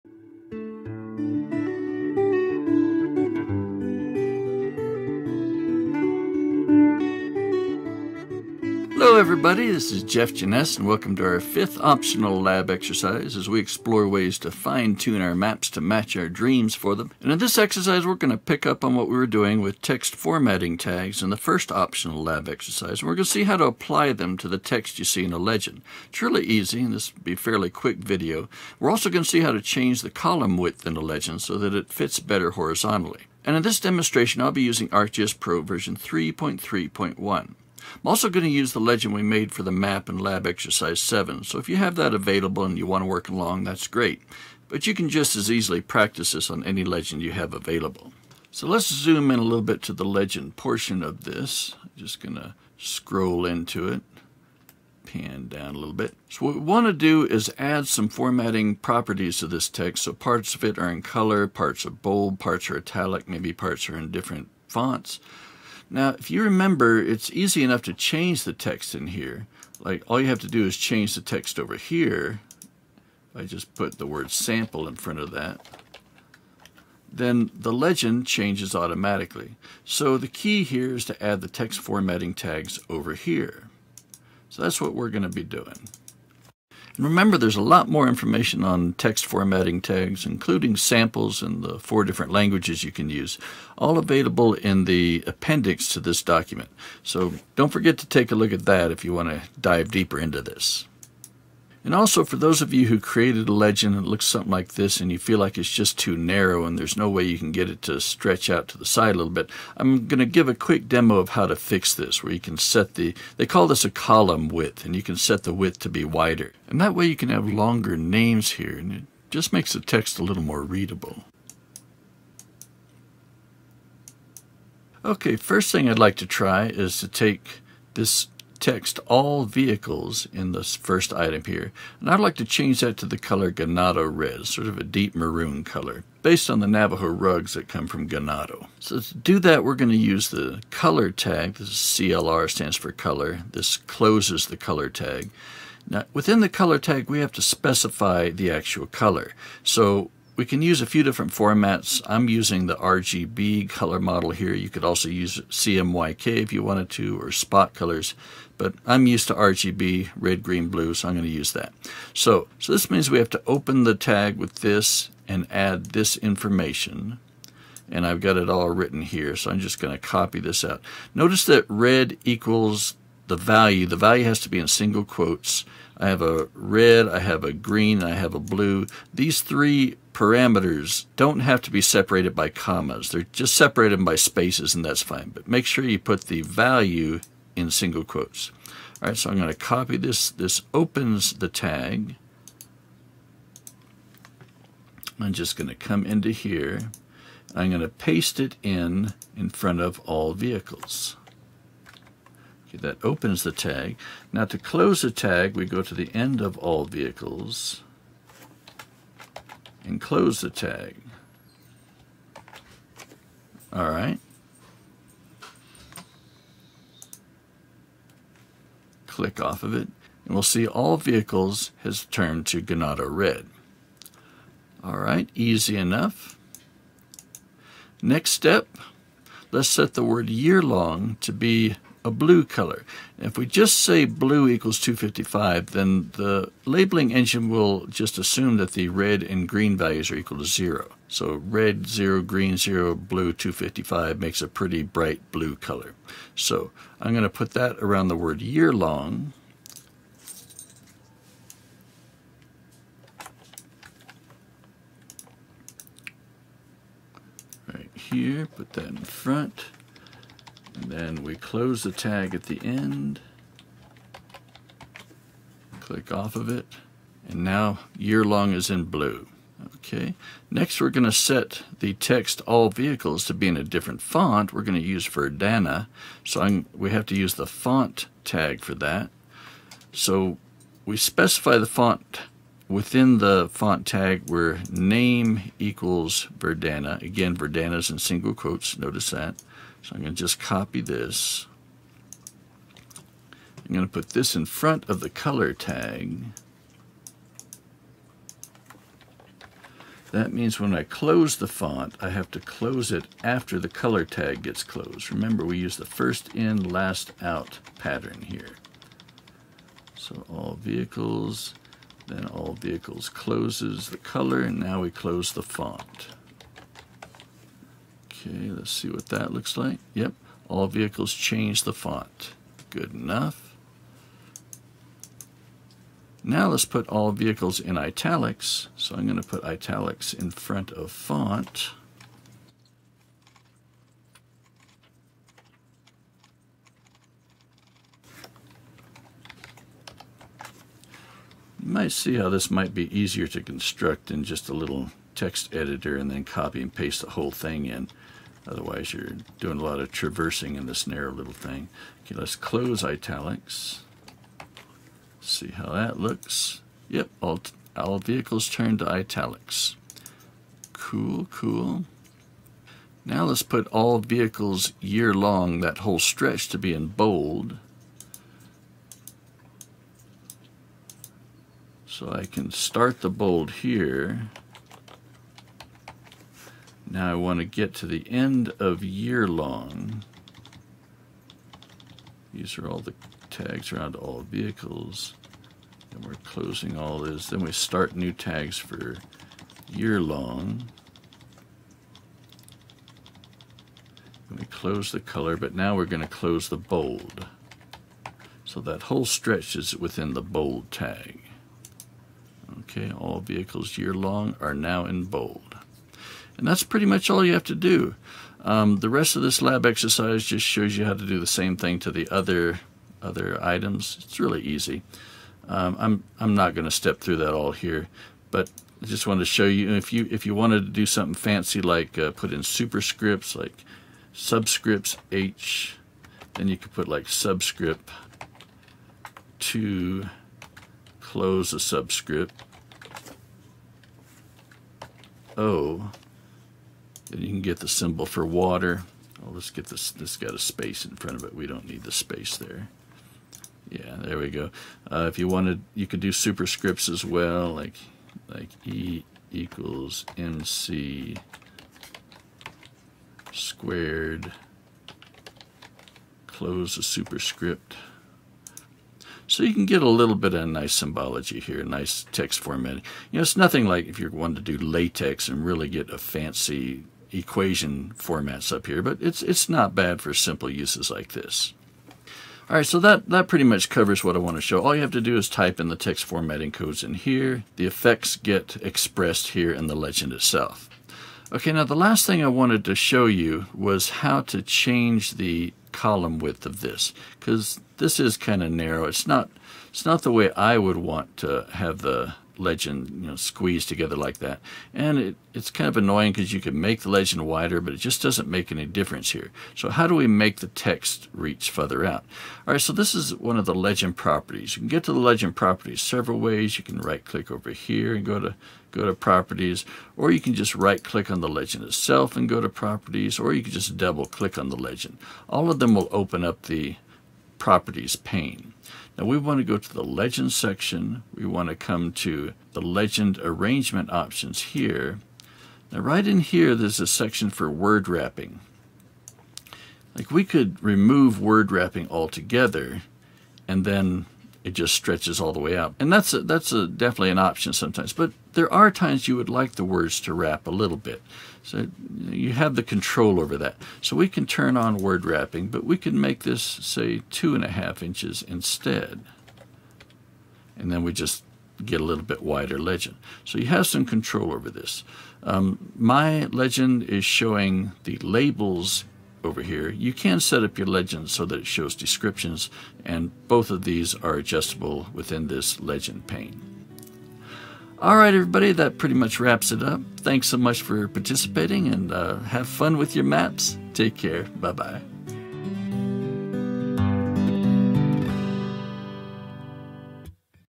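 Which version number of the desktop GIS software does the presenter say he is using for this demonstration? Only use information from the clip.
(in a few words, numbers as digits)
3.3.1.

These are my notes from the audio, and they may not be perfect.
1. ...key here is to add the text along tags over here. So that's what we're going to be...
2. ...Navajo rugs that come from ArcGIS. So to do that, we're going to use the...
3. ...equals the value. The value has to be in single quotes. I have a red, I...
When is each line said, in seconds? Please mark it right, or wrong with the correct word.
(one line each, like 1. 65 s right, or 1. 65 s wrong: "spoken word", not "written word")
1. 80 s wrong: "formatting", not "along"
2. 136 s wrong: "Ganado", not "ArcGIS"
3. 172 s right.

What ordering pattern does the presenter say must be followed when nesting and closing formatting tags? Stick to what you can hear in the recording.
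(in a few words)
first in, last out.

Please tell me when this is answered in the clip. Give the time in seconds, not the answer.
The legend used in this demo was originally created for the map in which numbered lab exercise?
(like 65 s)
40 s.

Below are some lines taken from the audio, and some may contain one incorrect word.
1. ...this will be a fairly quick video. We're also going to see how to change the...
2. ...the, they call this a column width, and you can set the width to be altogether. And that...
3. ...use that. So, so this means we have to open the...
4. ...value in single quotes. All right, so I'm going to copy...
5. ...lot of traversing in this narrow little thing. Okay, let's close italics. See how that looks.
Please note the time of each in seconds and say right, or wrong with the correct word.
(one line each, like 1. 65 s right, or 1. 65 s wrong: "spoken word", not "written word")
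1. 26 s right
2. 112 s wrong: "wider", not "altogether"
3. 161 s right
4. 186 s right
5. 349 s right.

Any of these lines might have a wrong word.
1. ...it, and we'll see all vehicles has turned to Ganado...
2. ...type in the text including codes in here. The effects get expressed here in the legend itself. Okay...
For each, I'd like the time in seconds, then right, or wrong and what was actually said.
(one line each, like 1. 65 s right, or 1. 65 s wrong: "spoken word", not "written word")
1. 219 s right
2. 475 s wrong: "formatting", not "including".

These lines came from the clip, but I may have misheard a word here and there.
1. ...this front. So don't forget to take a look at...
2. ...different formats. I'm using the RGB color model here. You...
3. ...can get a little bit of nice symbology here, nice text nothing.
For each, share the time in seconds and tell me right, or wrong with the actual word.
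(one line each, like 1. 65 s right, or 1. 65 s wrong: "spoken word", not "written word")
1. 96 s wrong: "document", not "front"
2. 151 s right
3. 459 s wrong: "formatting", not "nothing".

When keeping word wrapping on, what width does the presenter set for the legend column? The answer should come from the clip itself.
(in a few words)
2.5 inches.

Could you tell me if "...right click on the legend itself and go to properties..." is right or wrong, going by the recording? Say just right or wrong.
right.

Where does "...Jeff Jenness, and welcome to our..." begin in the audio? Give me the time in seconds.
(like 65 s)
10 s.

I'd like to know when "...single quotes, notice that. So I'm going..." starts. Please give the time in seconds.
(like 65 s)
287 s.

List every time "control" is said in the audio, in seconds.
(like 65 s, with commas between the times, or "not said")
542 s, 553 s.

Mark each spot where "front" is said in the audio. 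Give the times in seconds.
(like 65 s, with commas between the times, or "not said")
74 s, 199 s, 258 s, 294 s, 330 s, 440 s.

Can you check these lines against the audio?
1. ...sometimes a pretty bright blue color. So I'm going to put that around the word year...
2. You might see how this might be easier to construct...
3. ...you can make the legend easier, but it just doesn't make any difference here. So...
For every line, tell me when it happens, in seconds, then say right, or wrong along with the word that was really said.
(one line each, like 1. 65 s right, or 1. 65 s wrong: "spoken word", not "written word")
1. 244 s wrong: "makes", not "sometimes"
2. 341 s right
3. 496 s wrong: "wider", not "easier".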